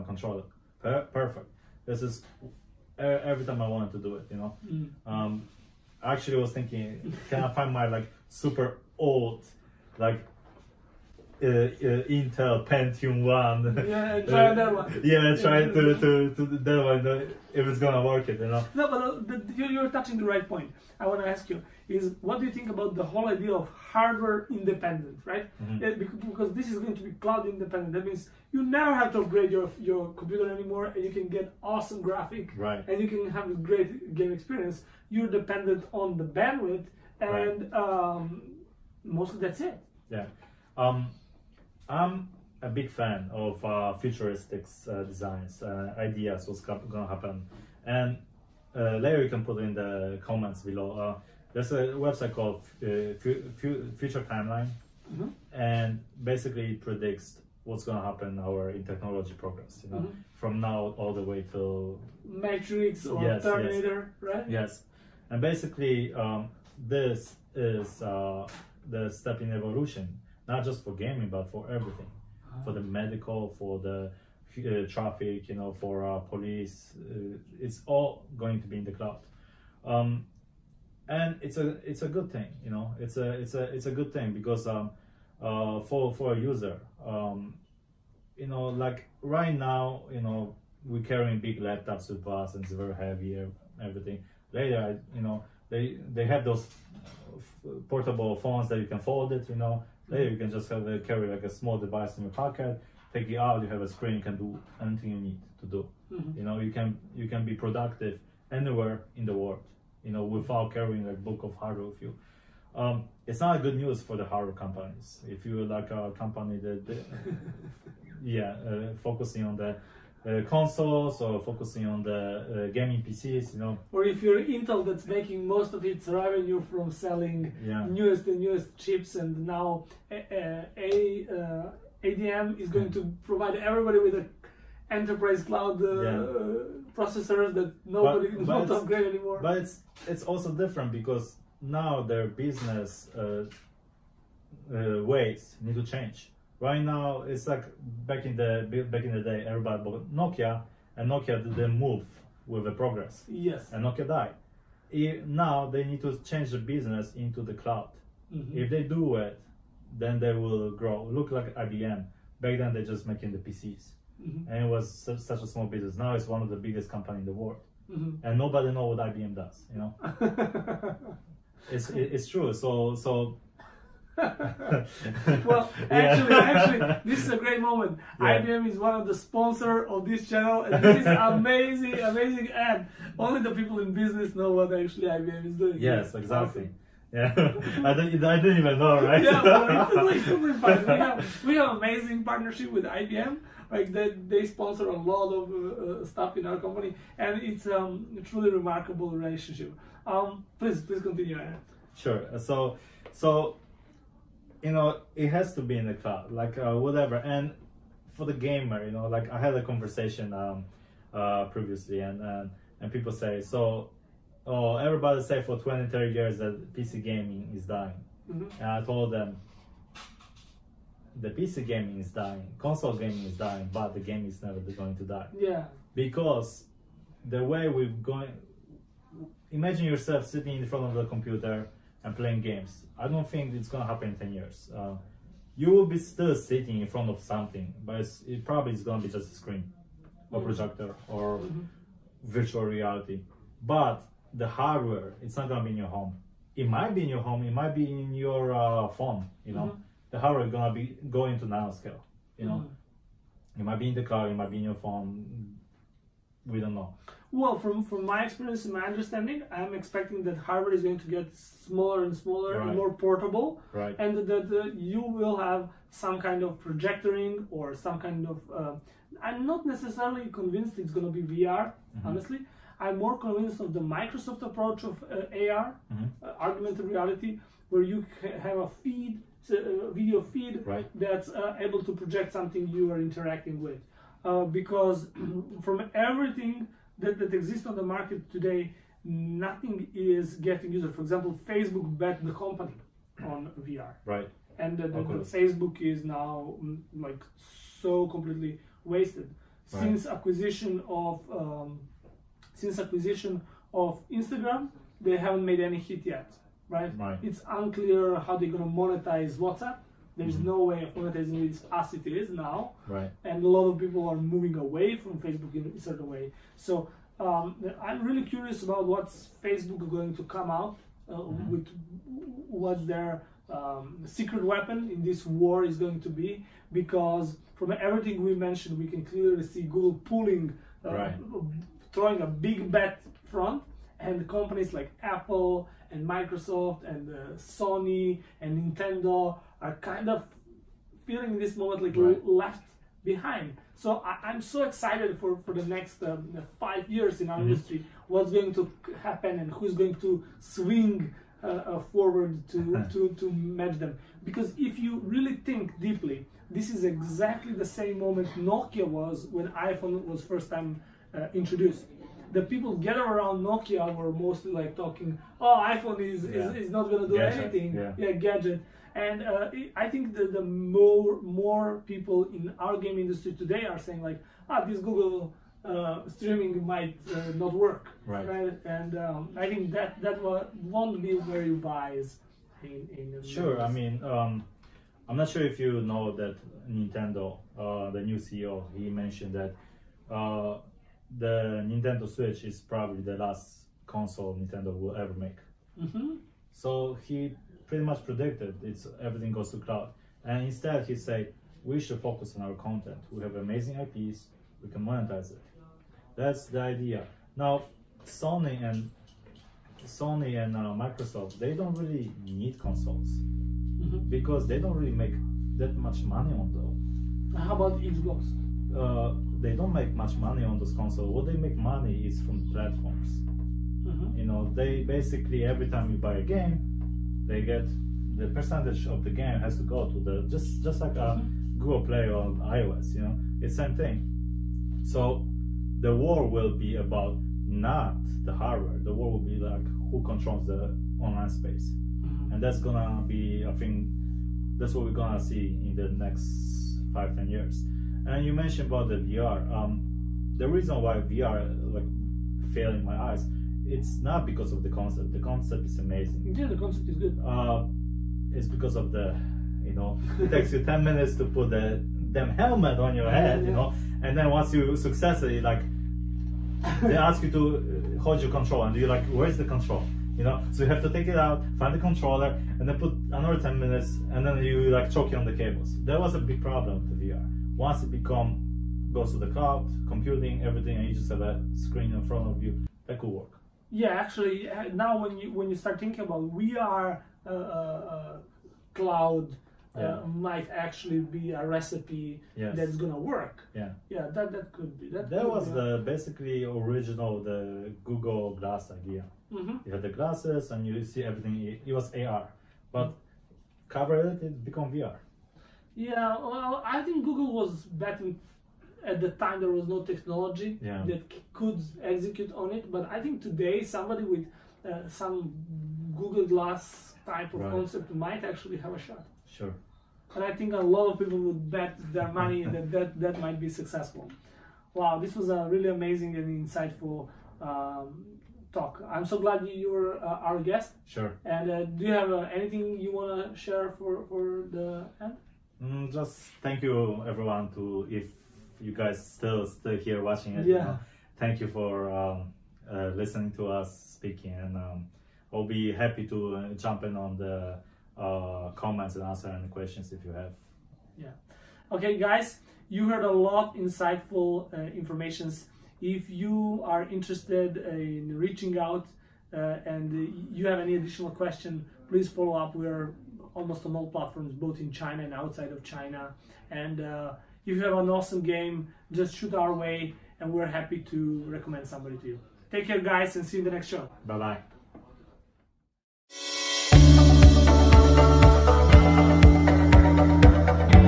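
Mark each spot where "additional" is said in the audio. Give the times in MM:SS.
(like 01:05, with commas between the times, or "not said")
09:20.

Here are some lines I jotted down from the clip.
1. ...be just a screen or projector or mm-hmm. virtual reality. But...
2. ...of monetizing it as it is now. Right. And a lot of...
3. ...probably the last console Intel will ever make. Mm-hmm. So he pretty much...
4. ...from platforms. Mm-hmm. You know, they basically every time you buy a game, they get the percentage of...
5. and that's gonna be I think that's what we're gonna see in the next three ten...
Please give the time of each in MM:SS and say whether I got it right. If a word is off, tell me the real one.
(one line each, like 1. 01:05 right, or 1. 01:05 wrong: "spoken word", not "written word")
1. 03:59 right
2. 05:10 right
3. 06:32 wrong: "Nintendo", not "Intel"
4. 07:02 right
5. 07:22 wrong: "five", not "three".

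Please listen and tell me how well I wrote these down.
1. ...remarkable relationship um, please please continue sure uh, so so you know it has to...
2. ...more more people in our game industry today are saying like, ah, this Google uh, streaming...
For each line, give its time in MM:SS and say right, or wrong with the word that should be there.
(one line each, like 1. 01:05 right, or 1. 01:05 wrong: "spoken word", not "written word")
1. 03:18 right
2. 06:10 right.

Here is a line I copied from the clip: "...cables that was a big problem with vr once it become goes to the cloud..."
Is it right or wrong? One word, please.
right.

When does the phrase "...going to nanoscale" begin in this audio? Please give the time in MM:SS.
04:11.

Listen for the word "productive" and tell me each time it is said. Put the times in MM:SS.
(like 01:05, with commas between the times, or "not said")
01:47.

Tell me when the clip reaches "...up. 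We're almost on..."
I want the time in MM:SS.
09:22.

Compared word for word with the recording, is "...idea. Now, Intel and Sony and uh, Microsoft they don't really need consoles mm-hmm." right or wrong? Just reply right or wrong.
wrong.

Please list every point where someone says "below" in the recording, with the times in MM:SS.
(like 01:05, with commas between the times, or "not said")
00:50.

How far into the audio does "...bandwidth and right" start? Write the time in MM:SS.
00:36.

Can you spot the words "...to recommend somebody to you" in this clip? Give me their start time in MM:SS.
09:30.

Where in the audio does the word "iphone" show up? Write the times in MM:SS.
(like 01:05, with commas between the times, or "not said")
05:59, 06:05.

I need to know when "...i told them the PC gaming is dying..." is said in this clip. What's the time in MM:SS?
03:38.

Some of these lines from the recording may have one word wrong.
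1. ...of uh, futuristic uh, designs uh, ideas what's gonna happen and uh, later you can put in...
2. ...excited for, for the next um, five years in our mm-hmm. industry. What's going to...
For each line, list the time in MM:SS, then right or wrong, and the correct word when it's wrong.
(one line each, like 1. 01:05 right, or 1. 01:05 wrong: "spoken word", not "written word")
1. 00:43 right
2. 05:44 right.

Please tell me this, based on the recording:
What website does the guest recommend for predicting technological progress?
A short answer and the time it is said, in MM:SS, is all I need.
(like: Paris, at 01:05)
Future Timeline, at 00:54.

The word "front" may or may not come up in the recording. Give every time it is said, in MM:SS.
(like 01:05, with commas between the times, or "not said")
03:50, 03:56, 05:33, 08:02.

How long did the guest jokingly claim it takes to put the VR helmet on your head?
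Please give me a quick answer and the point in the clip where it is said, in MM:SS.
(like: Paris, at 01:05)
10 minutes, at 07:40.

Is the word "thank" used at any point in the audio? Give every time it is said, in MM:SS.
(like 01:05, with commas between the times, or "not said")
08:56, 09:01.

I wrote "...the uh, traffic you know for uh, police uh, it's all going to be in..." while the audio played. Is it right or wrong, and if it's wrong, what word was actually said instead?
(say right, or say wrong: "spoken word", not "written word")
right.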